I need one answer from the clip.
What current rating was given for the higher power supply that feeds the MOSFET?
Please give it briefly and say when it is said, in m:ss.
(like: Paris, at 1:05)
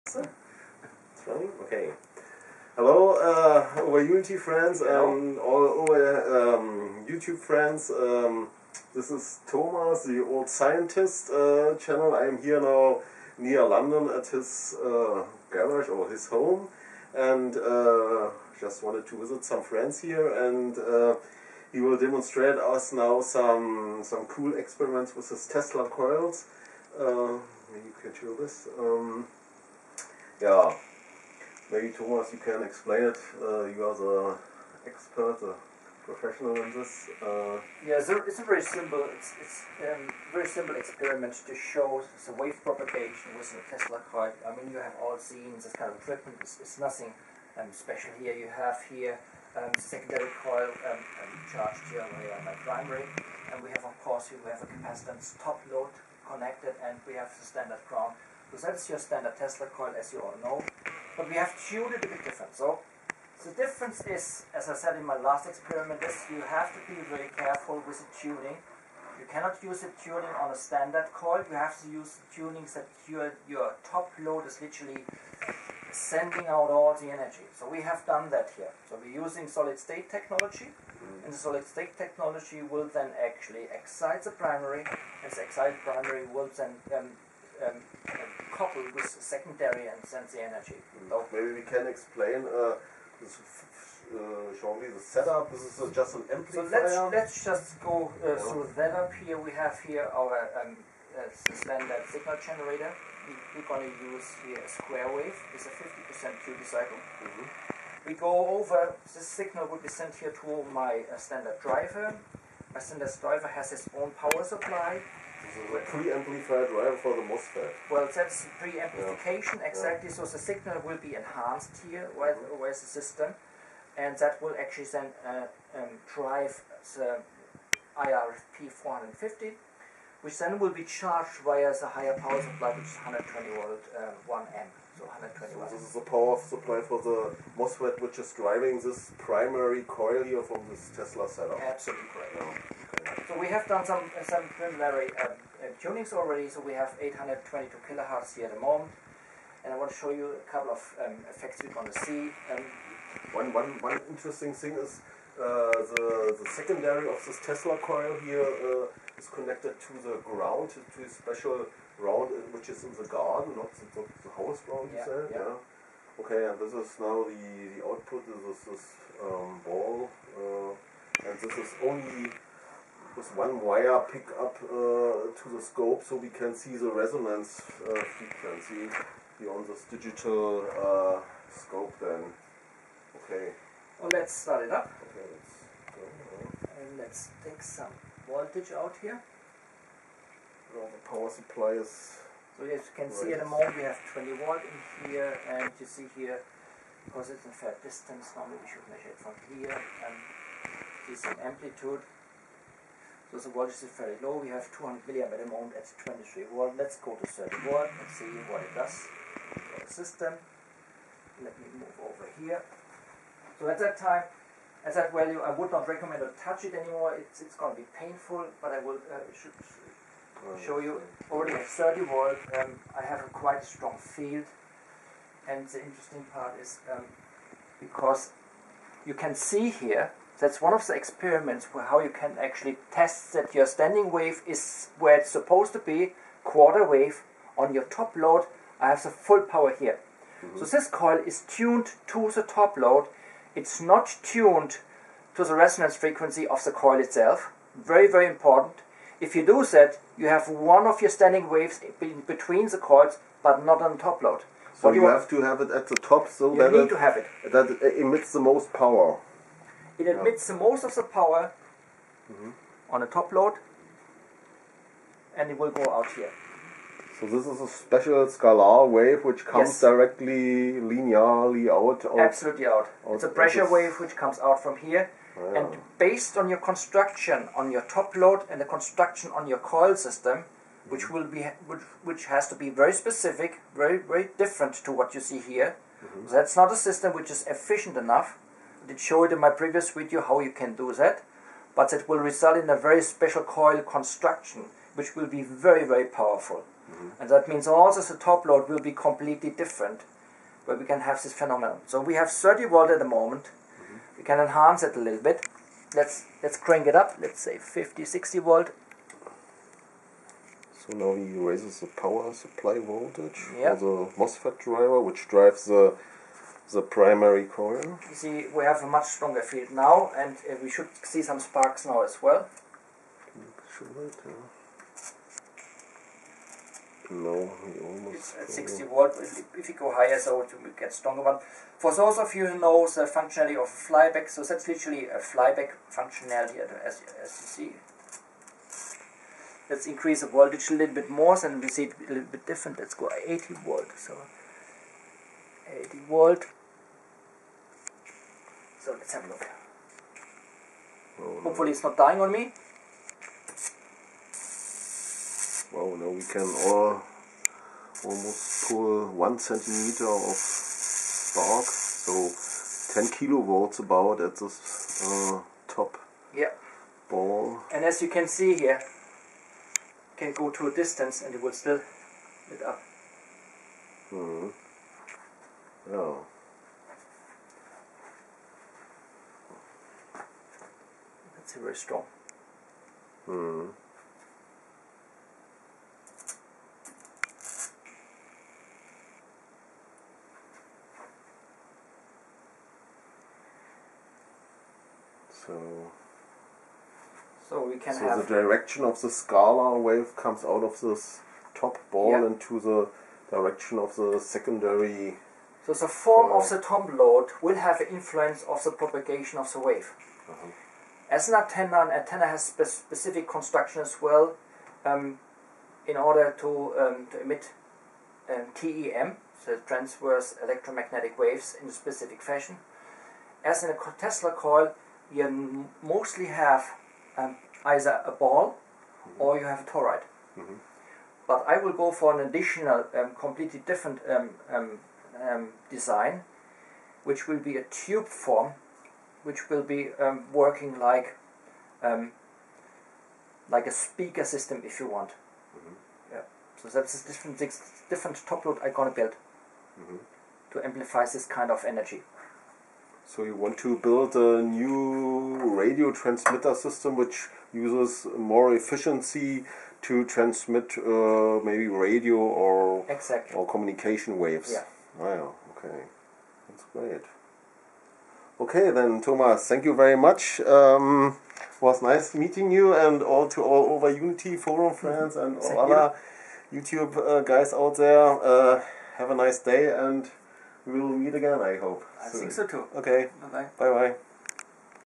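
1 amp, at 2:14.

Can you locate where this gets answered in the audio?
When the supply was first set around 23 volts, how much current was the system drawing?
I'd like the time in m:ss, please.
3:24.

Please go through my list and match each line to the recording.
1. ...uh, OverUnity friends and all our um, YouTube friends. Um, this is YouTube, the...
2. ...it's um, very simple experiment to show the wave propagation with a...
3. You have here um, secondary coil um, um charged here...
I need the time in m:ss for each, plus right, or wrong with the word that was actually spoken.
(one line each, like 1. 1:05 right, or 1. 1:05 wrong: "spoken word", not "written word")
1. 0:03 wrong: "Thomas", not "YouTube"
2. 0:39 right
3. 0:48 right.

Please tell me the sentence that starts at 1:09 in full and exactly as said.
You cannot use the tuning on a standard coil.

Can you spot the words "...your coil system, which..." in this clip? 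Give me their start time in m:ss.
4:39.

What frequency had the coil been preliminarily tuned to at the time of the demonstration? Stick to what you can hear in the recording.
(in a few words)
822 kilohertz.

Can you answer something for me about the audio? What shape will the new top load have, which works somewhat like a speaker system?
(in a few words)
Tube form.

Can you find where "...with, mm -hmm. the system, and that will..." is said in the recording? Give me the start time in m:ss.
2:02.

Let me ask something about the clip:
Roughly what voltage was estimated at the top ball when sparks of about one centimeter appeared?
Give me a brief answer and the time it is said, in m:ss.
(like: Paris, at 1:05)
10 kilovolts, at 6:03.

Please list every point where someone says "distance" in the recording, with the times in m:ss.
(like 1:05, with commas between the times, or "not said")
3:17, 6:10.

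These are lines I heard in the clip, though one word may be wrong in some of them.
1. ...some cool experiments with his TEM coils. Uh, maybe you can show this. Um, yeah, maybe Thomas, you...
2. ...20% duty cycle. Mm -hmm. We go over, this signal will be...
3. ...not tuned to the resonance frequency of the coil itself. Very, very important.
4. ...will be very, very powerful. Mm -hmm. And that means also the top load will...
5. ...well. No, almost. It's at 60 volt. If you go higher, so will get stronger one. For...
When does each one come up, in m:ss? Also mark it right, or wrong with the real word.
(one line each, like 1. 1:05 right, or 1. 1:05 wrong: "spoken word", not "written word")
1. 0:24 wrong: "Tesla", not "TEM"
2. 1:45 wrong: "50", not "20"
3. 4:03 right
4. 4:55 right
5. 5:22 right.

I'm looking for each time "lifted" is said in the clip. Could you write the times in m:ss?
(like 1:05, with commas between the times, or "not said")
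not said.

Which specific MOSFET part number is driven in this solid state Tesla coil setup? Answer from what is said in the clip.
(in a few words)
IRFP 450.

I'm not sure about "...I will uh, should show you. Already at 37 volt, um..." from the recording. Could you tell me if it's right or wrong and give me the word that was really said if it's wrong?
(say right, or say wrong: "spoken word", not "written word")
wrong: "30", not "37".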